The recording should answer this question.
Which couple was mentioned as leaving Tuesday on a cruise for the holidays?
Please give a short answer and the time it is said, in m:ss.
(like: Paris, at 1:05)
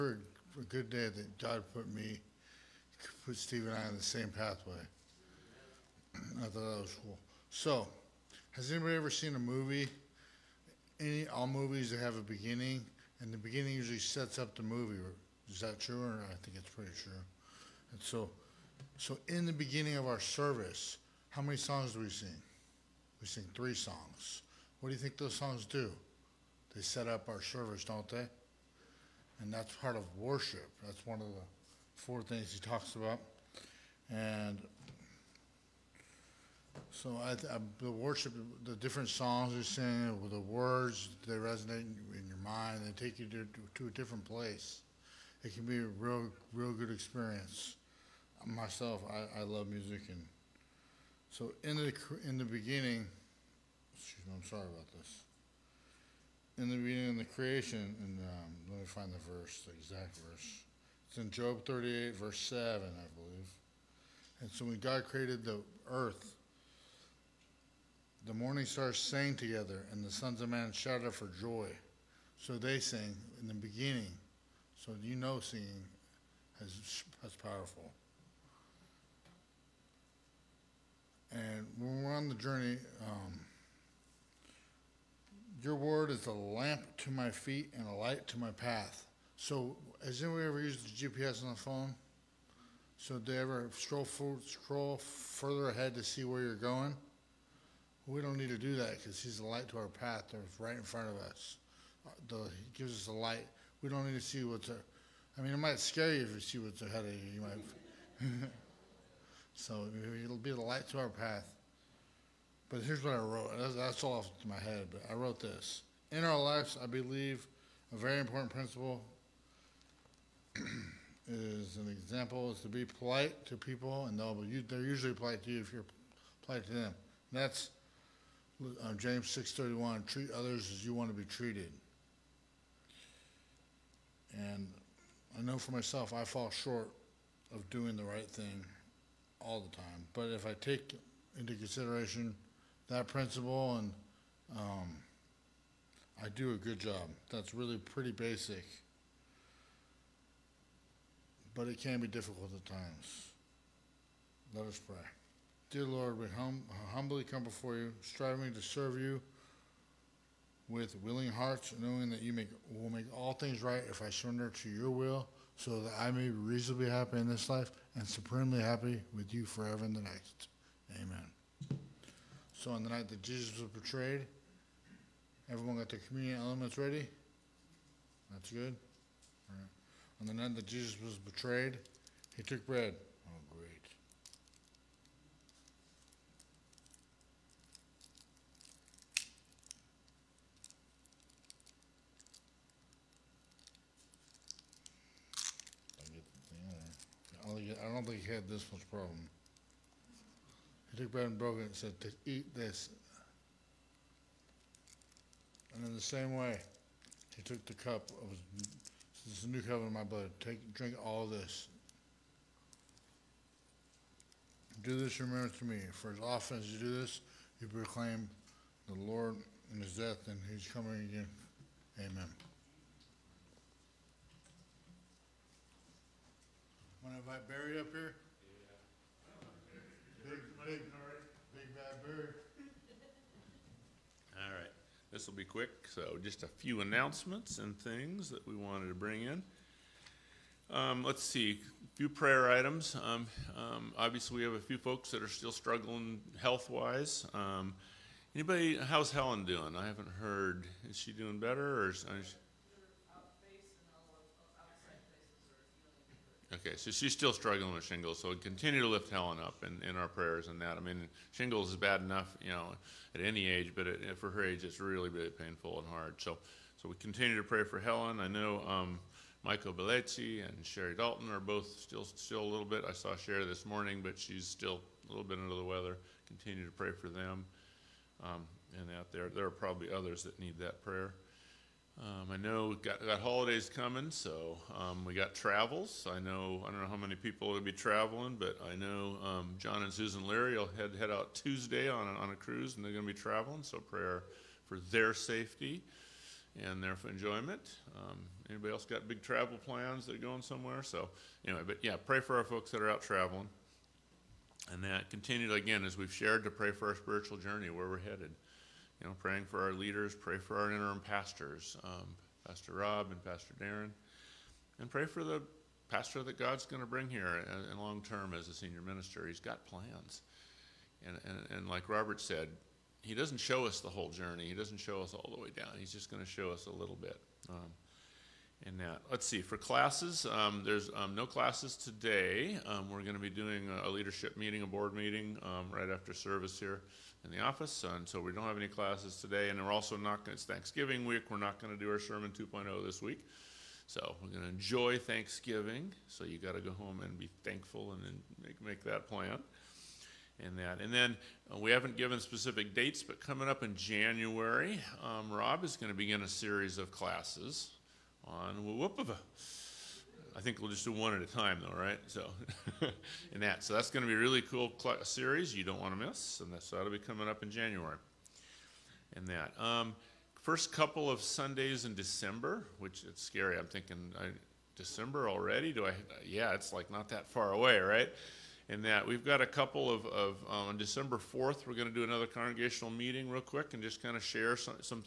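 John and Susan Leary, at 4:49.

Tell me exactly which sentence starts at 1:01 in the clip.
It's in Job 38, verse 7, I believe.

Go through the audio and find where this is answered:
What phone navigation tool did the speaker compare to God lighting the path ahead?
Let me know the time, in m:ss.
1:31.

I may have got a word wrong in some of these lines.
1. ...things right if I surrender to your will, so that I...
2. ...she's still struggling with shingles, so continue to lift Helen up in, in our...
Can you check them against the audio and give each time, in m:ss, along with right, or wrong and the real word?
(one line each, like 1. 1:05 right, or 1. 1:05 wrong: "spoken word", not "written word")
1. 2:43 right
2. 4:16 right.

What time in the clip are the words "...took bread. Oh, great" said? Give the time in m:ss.
3:02.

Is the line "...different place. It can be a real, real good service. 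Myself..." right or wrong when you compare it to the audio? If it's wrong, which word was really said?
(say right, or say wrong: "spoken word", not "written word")
wrong: "experience", not "service".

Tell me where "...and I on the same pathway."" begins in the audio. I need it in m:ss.
0:03.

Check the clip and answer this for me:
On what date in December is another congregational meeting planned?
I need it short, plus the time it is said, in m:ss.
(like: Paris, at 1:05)
December 4, at 6:20.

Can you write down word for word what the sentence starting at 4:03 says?
Um, um, obviously, we have a few folks that are still struggling health-wise.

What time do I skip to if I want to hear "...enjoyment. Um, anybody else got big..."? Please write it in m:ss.
4:57.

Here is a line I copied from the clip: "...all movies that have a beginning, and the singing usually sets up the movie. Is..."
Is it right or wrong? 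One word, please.
wrong.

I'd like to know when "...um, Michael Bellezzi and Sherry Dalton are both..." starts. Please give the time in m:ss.
4:28.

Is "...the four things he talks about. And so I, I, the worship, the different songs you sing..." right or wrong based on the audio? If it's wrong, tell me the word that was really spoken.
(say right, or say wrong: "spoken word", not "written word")
right.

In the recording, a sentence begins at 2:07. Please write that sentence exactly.
And that's uh, James 6.31, treat others as you want to be treated.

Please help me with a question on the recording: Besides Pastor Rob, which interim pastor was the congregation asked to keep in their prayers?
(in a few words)
Pastor Darren.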